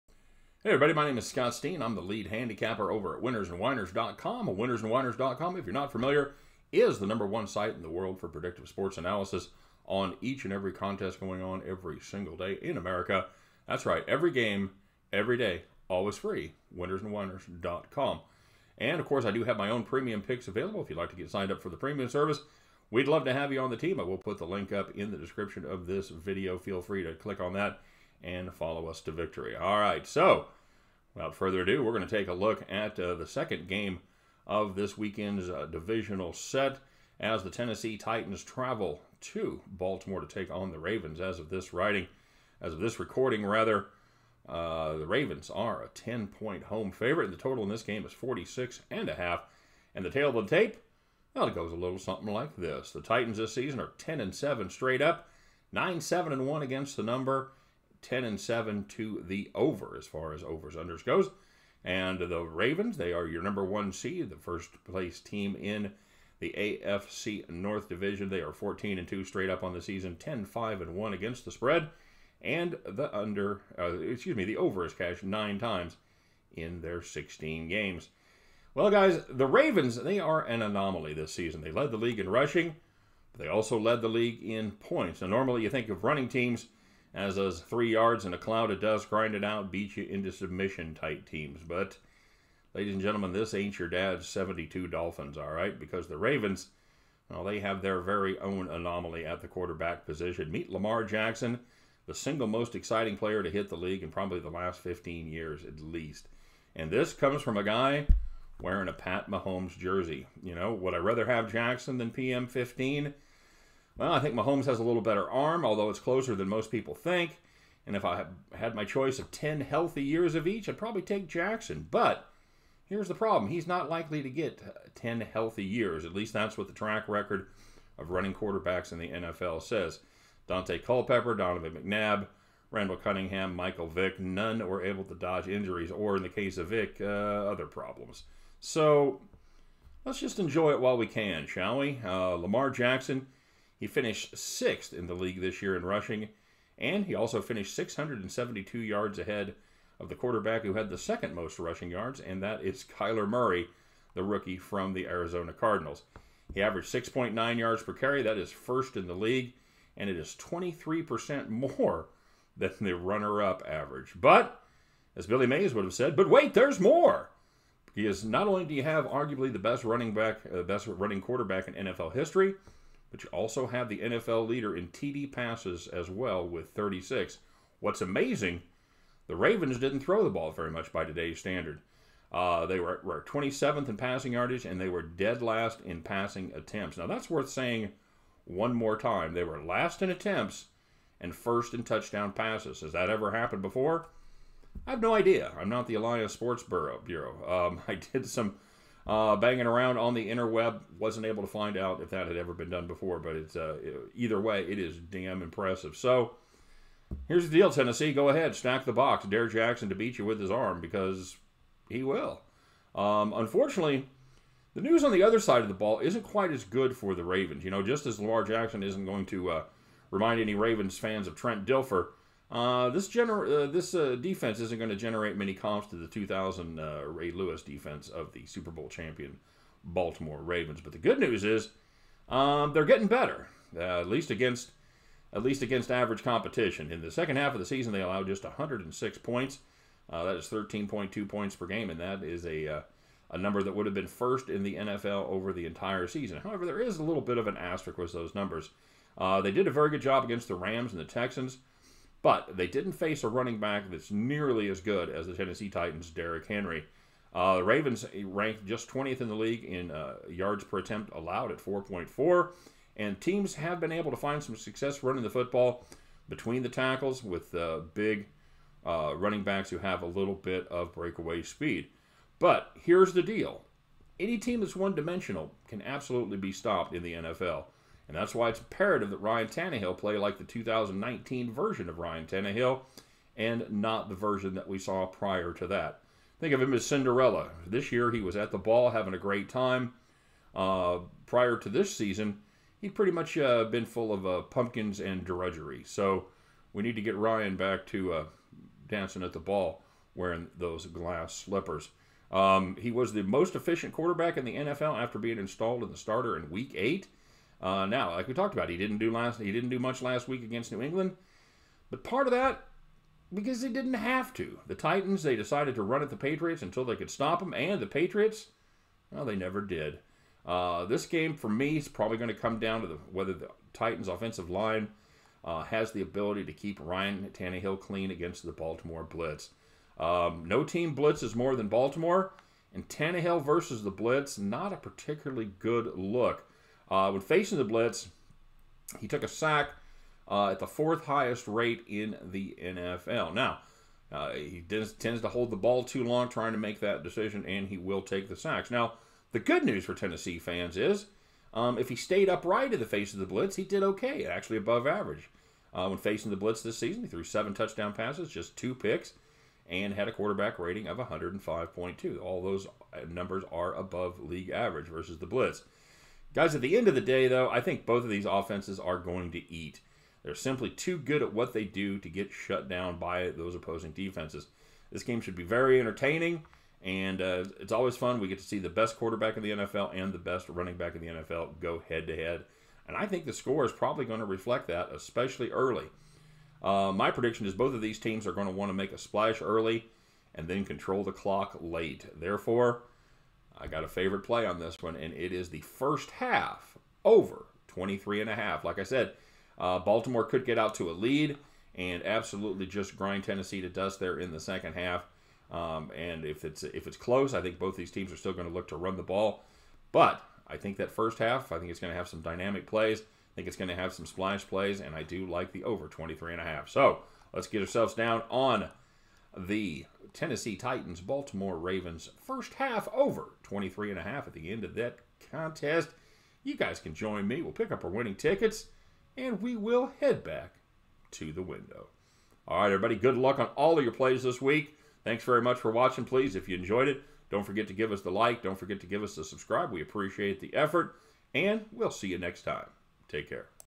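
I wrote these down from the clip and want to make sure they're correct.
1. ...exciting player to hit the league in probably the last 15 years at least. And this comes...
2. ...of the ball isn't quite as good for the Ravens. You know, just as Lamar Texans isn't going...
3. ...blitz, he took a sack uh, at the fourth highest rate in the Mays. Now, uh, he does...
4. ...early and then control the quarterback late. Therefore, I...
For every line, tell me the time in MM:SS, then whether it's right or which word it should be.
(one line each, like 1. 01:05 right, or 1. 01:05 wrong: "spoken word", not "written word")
1. 01:42 right
2. 03:35 wrong: "Jackson", not "Texans"
3. 05:37 wrong: "NFL", not "Mays"
4. 06:29 wrong: "clock", not "quarterback".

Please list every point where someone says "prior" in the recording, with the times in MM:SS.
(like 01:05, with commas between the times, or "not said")
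04:45, 04:51.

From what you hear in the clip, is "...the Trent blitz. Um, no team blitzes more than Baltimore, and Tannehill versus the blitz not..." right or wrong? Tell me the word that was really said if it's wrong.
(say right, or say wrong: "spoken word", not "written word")
wrong: "Baltimore", not "Trent".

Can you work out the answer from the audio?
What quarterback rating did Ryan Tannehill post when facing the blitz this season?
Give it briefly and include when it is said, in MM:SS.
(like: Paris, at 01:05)
105.2, at 06:00.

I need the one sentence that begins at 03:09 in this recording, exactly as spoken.
They were last in attempts and first in touchdown passes.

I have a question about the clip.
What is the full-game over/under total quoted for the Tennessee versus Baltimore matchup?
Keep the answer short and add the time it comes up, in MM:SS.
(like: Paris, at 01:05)
46.5, at 00:48.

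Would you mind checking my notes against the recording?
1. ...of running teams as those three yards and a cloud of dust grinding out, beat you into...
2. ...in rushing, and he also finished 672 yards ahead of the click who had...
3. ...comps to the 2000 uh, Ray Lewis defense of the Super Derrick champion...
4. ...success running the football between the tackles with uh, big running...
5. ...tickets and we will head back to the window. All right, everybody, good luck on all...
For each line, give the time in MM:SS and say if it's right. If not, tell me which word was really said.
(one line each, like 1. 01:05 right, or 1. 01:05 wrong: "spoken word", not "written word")
1. 01:25 right
2. 02:25 wrong: "quarterback", not "click"
3. 03:45 wrong: "Bowl", not "Derrick"
4. 04:24 right
5. 07:08 right.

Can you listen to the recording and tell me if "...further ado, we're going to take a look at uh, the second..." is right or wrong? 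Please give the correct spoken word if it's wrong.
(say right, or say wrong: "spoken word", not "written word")
right.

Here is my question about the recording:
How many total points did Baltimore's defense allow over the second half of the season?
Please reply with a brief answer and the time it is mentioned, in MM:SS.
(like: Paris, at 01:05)
106, at 03:58.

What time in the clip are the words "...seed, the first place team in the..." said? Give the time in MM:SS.
01:03.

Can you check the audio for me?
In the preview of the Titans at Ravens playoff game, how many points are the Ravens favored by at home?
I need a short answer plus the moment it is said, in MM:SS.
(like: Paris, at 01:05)
10, at 00:45.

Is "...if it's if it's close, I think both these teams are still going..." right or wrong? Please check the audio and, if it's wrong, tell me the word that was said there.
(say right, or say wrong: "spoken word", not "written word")
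right.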